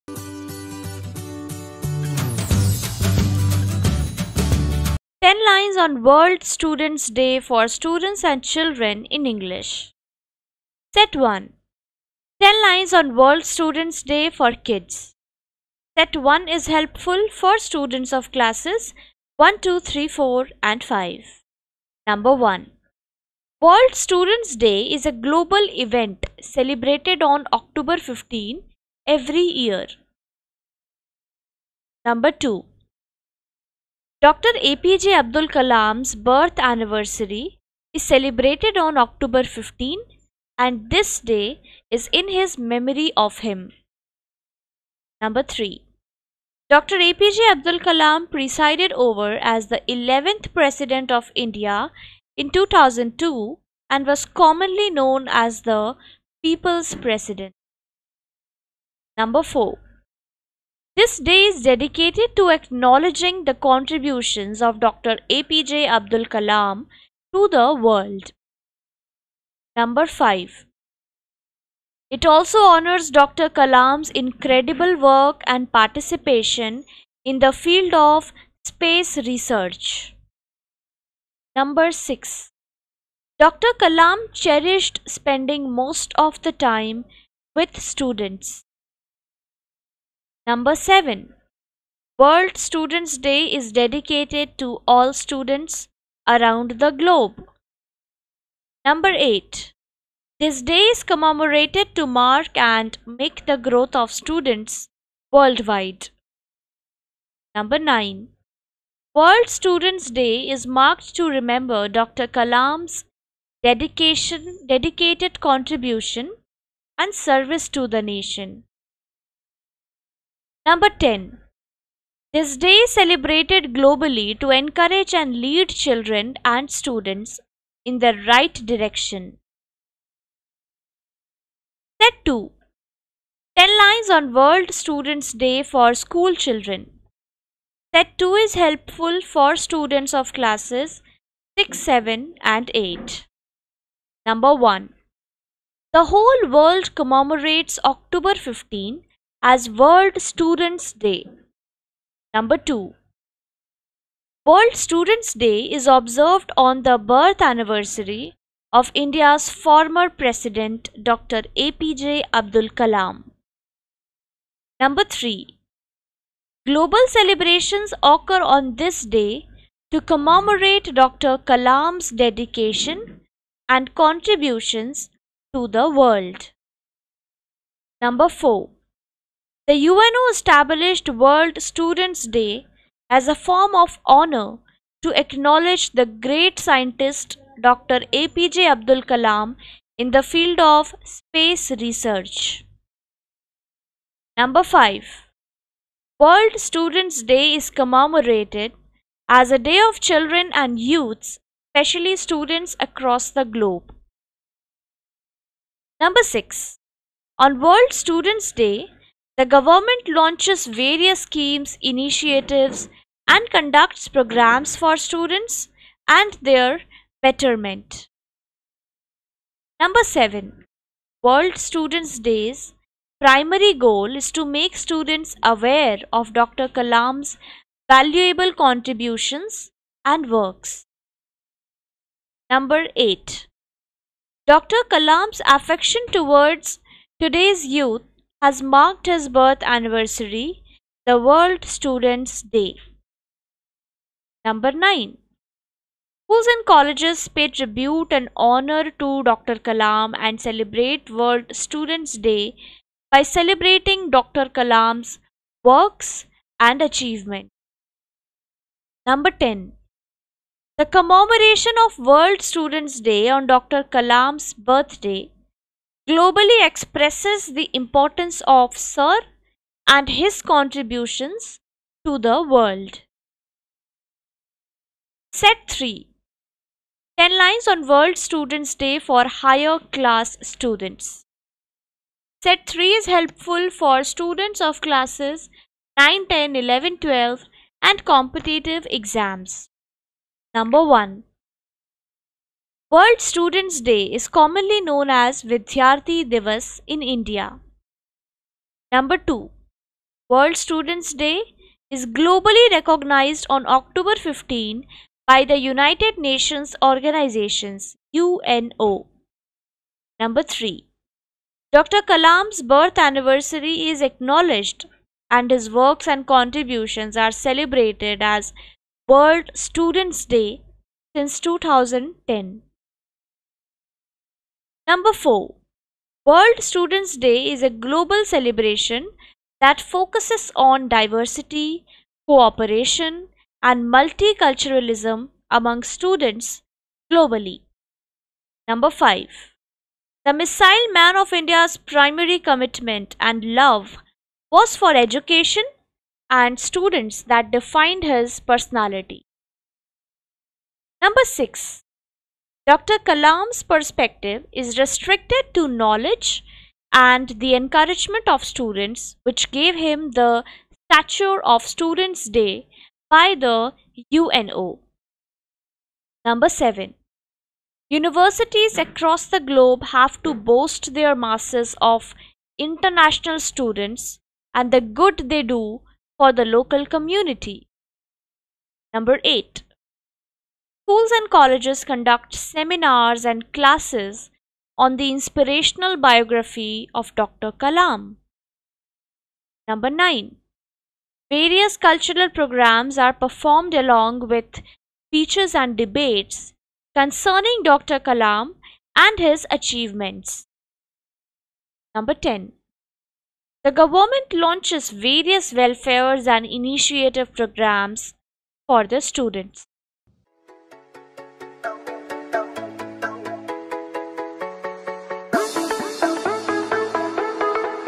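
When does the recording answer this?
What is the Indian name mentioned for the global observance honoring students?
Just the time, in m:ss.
4:55.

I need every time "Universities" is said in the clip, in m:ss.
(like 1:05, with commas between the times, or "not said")
6:07.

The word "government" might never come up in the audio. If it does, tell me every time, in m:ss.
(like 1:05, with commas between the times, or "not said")
3:29, 6:43.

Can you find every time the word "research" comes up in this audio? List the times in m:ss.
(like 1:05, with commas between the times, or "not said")
1:19, 3:11.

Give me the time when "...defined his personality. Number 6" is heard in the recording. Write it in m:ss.
5:47.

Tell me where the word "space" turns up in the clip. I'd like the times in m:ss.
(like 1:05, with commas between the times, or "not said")
1:18, 3:11.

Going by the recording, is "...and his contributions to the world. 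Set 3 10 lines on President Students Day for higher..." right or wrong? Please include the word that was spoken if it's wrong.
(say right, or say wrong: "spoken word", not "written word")
wrong: "World", not "President".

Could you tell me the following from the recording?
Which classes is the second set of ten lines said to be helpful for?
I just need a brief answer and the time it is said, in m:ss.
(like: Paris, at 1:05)
6, 7 and 8, at 2:21.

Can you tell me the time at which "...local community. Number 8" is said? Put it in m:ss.
6:16.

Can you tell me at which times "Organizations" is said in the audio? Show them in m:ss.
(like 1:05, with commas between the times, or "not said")
5:06.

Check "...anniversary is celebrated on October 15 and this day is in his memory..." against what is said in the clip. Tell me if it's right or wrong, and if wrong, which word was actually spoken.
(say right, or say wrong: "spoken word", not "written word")
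right.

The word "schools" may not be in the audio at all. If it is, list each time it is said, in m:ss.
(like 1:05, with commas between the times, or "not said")
2:15, 4:06, 6:20.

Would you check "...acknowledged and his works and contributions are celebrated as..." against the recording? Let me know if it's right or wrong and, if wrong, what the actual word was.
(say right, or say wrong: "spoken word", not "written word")
right.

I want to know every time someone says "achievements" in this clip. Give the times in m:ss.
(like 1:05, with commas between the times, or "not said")
4:16, 6:39.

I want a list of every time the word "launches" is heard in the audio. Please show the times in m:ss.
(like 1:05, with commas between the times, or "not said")
3:30, 6:44.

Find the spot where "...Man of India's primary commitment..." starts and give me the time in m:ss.
5:40.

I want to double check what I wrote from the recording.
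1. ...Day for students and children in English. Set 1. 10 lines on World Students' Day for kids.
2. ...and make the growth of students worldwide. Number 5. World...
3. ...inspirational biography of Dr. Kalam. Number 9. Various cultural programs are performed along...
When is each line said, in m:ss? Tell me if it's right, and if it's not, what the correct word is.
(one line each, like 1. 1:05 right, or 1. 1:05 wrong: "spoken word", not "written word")
1. 0:07 right
2. 1:42 wrong: "9", not "5"
3. 6:25 right.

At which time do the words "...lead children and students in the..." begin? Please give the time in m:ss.
2:05.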